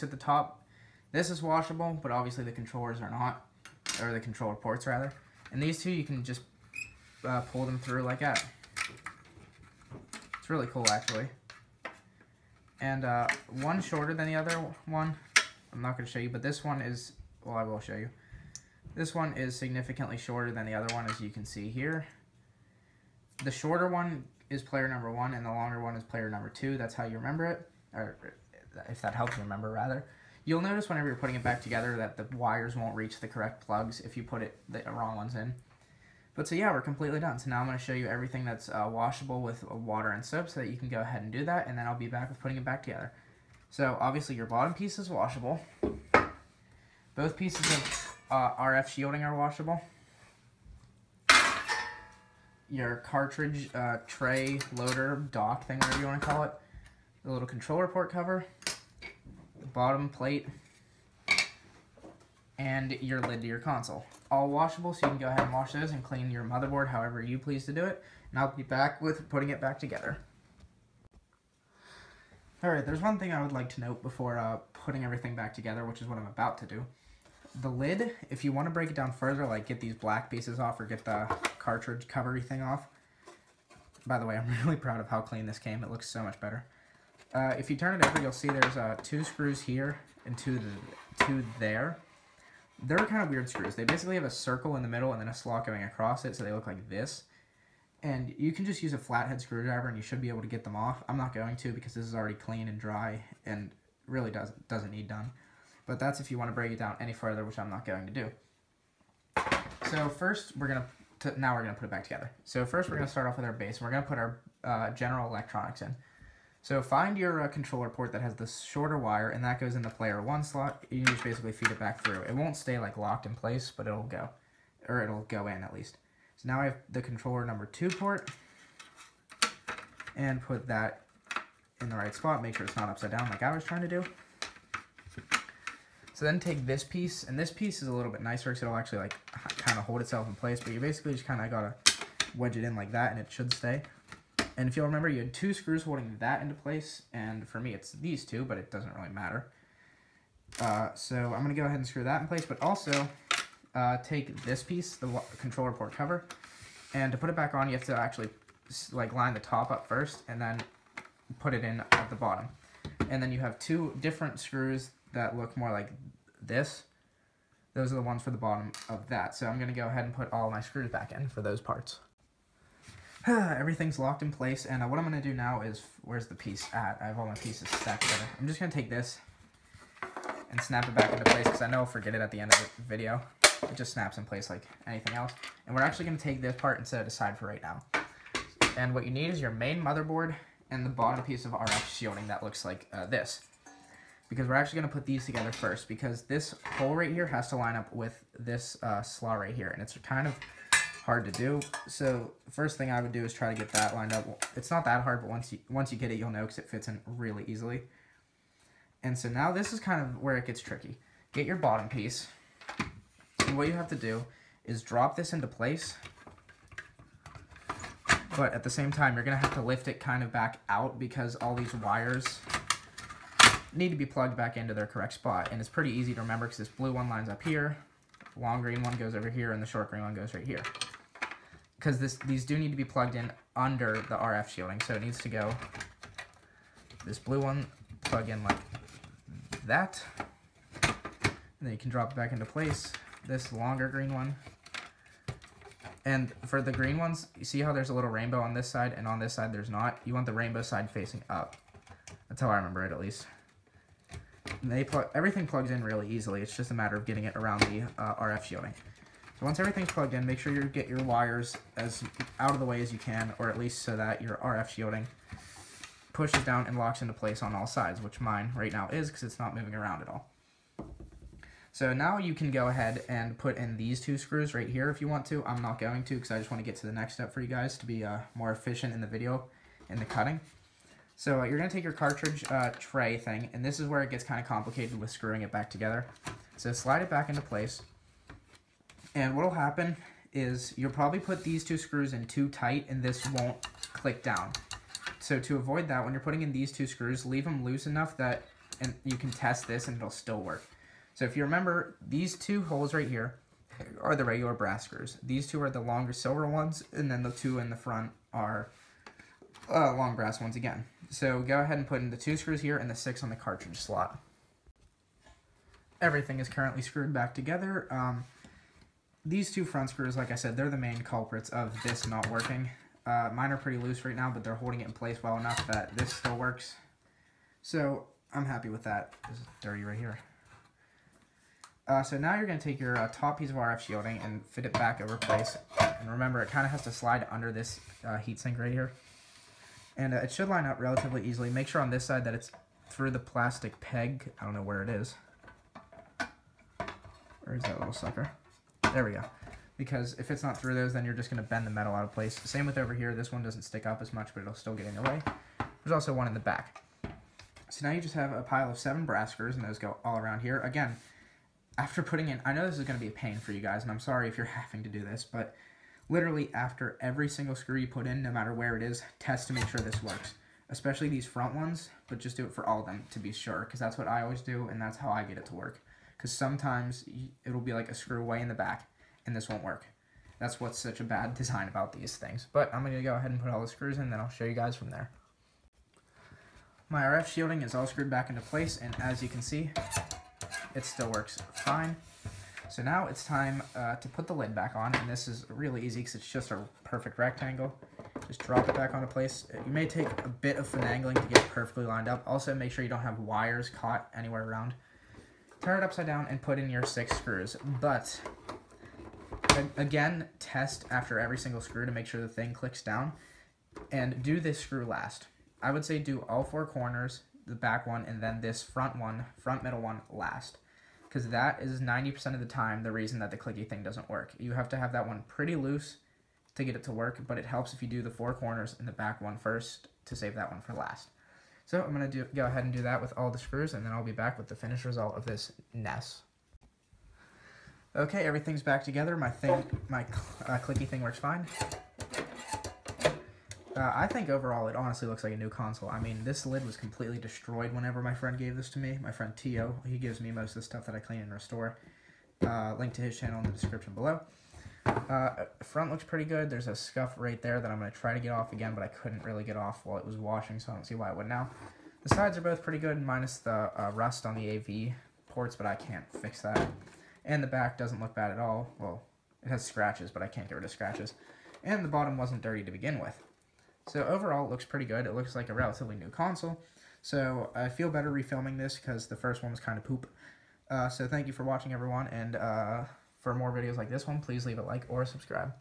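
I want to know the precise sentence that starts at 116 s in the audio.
So find your uh, controller port that has the shorter wire, and that goes in the player one slot.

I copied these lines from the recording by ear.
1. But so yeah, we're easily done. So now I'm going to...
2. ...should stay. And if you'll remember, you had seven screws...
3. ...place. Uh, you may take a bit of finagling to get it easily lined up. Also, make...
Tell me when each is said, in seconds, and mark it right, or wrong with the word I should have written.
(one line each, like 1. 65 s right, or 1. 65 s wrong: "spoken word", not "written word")
1. 36 s wrong: "completely", not "easily"
2. 143 s wrong: "two", not "seven"
3. 399 s wrong: "perfectly", not "easily".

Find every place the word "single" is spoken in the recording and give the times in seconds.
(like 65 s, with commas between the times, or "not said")
367 s, 411 s.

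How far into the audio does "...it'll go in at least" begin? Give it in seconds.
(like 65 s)
125 s.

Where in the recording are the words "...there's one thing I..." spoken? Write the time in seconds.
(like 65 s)
72 s.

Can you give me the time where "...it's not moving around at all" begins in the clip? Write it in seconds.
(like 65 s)
269 s.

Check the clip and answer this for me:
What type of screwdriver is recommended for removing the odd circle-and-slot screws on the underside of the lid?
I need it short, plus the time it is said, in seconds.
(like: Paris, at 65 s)
Flathead, at 98 s.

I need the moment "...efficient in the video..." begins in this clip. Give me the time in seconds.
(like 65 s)
278 s.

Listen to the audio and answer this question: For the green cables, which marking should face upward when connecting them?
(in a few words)
Rainbow side.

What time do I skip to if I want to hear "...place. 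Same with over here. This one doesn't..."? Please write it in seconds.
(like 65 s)
352 s.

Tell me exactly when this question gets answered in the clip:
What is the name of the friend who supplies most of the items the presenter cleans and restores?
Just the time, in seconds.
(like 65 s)
449 s.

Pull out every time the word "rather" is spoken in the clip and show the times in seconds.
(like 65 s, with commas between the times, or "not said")
4 s, 29 s.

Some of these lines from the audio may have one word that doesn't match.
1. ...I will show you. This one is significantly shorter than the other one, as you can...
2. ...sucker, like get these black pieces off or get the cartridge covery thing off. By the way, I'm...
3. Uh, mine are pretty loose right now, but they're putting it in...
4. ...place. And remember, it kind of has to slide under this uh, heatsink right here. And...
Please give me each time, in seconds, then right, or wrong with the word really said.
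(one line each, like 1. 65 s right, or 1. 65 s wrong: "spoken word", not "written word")
1. 17 s right
2. 79 s wrong: "further", not "sucker"
3. 323 s wrong: "holding", not "putting"
4. 335 s right.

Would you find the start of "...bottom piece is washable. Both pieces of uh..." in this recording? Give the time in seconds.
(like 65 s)
44 s.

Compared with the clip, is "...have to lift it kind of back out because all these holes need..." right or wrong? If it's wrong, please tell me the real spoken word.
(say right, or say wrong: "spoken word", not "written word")
wrong: "wires", not "holes".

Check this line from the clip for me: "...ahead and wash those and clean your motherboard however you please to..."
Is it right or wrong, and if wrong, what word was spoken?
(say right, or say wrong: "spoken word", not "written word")
right.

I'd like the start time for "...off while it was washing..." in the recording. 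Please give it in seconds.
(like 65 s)
459 s.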